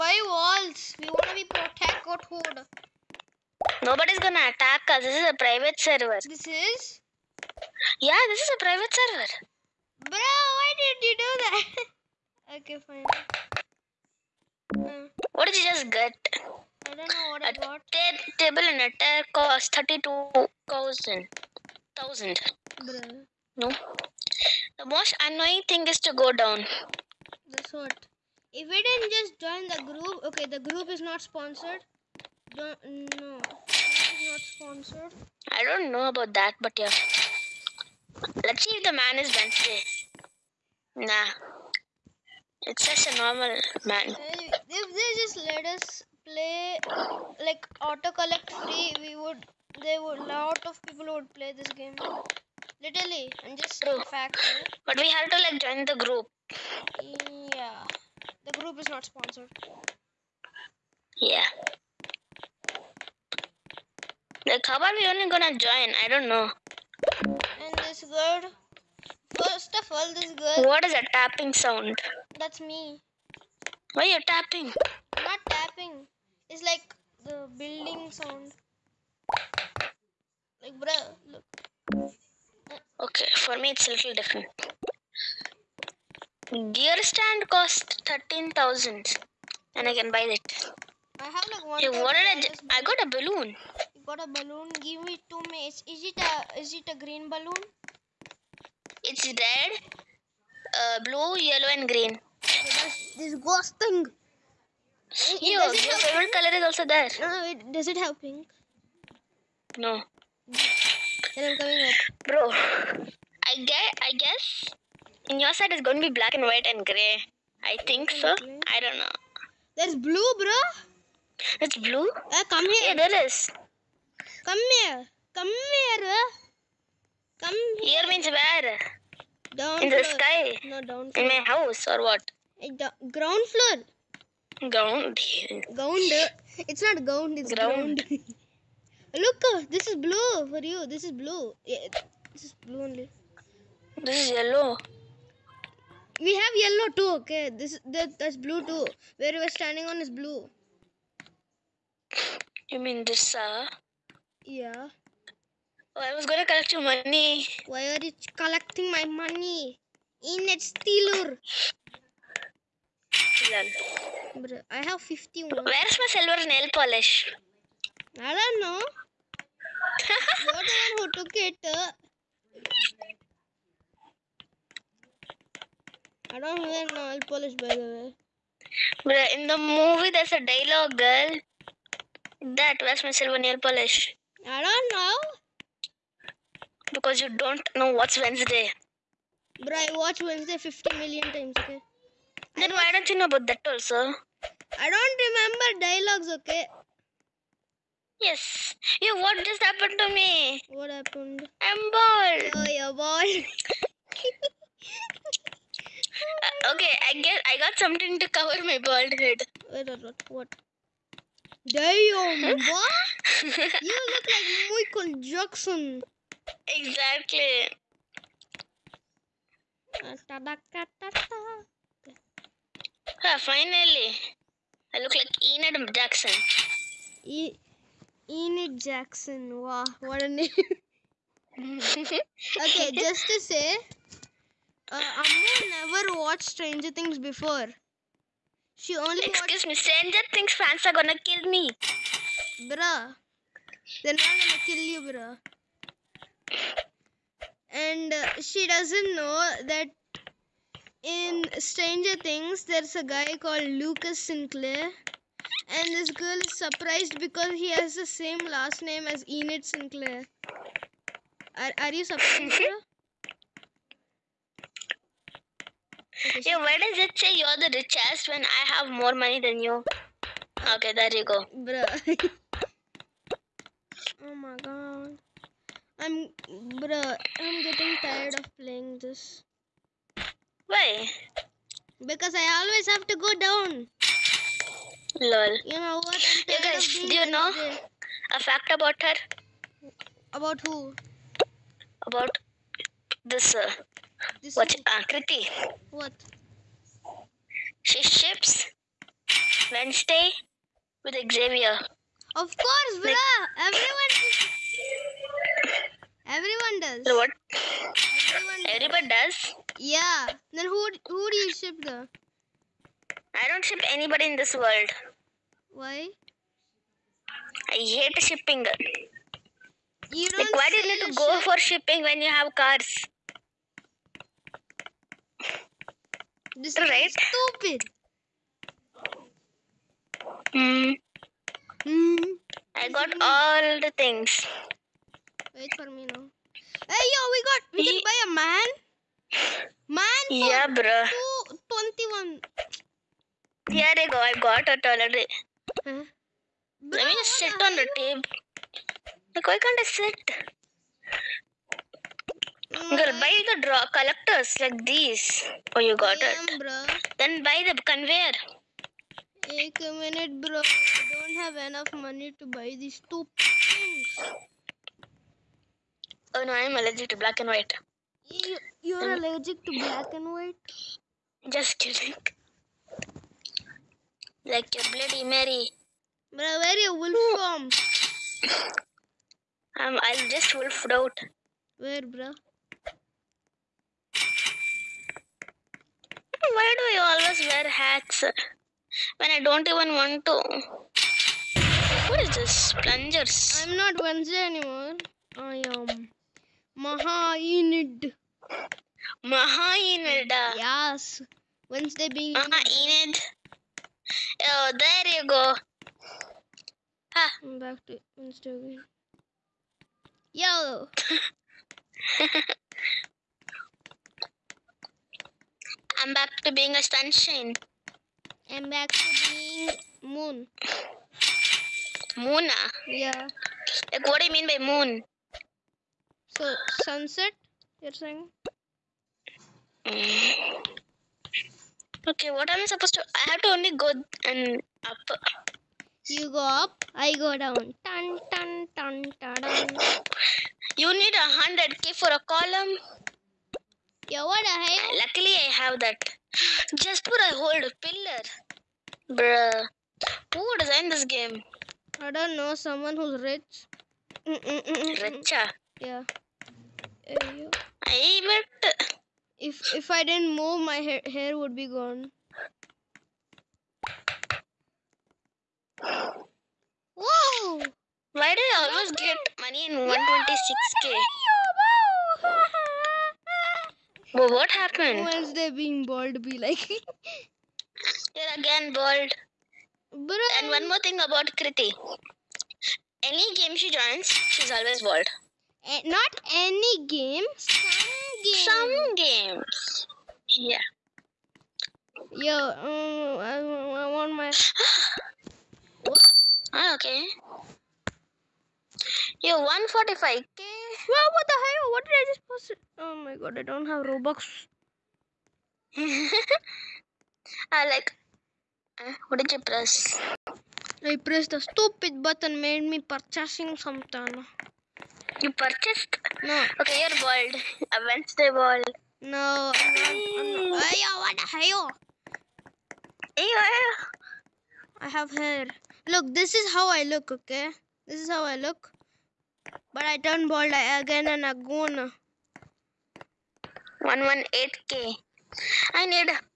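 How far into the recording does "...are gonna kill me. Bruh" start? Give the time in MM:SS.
04:00.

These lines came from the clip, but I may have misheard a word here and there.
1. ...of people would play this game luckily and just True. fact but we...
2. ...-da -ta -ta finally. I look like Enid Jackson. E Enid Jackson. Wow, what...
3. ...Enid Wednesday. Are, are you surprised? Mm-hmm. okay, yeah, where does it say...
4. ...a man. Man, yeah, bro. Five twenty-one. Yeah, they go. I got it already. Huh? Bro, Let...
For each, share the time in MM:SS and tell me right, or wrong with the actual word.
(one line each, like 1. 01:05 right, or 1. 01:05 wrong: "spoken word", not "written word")
1. 00:50 wrong: "literally", not "luckily"
2. 03:40 right
3. 04:19 wrong: "Sinclair", not "Wednesday"
4. 05:38 wrong: "Two", not "Five".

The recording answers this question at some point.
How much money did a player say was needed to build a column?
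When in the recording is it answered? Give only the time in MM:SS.
07:21.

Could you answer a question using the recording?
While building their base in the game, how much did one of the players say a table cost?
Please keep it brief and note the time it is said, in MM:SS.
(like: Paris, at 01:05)
32,000, at 00:19.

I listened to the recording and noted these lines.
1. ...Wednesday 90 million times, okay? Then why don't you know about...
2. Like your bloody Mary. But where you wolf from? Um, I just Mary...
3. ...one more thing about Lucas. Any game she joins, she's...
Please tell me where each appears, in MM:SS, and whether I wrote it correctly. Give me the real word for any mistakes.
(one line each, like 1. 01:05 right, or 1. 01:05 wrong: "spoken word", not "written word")
1. 03:10 wrong: "50", not "90"
2. 06:14 wrong: "Wolf", not "Mary"
3. 08:00 wrong: "Krithi", not "Lucas".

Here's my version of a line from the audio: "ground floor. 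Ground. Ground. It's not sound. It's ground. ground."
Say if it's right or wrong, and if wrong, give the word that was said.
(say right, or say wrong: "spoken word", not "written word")
wrong: "ground", not "sound".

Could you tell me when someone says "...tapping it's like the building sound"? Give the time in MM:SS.
01:15.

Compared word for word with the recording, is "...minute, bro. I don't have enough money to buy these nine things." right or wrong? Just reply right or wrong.
wrong.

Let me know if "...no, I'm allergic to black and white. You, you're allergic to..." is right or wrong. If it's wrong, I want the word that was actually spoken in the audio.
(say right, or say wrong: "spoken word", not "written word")
right.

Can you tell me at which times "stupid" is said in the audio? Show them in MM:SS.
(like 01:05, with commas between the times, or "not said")
05:27, 08:31.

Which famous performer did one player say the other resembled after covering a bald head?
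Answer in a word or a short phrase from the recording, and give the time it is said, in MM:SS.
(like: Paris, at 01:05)
Michael Jackson, at 03:34.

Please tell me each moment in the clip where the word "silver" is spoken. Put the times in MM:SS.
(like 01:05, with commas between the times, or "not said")
02:46, 03:03.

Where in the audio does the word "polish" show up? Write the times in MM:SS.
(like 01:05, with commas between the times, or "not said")
02:46, 02:57, 03:03.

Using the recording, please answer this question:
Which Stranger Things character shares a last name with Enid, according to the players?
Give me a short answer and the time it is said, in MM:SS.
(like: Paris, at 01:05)
Lucas Sinclair, at 04:13.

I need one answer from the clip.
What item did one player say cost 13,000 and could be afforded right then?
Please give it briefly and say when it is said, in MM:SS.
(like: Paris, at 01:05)
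Gear stand, at 01:26.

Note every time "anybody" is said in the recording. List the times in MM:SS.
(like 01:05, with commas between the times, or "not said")
05:13.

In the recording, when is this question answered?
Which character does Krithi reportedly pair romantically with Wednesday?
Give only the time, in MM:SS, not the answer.
05:01.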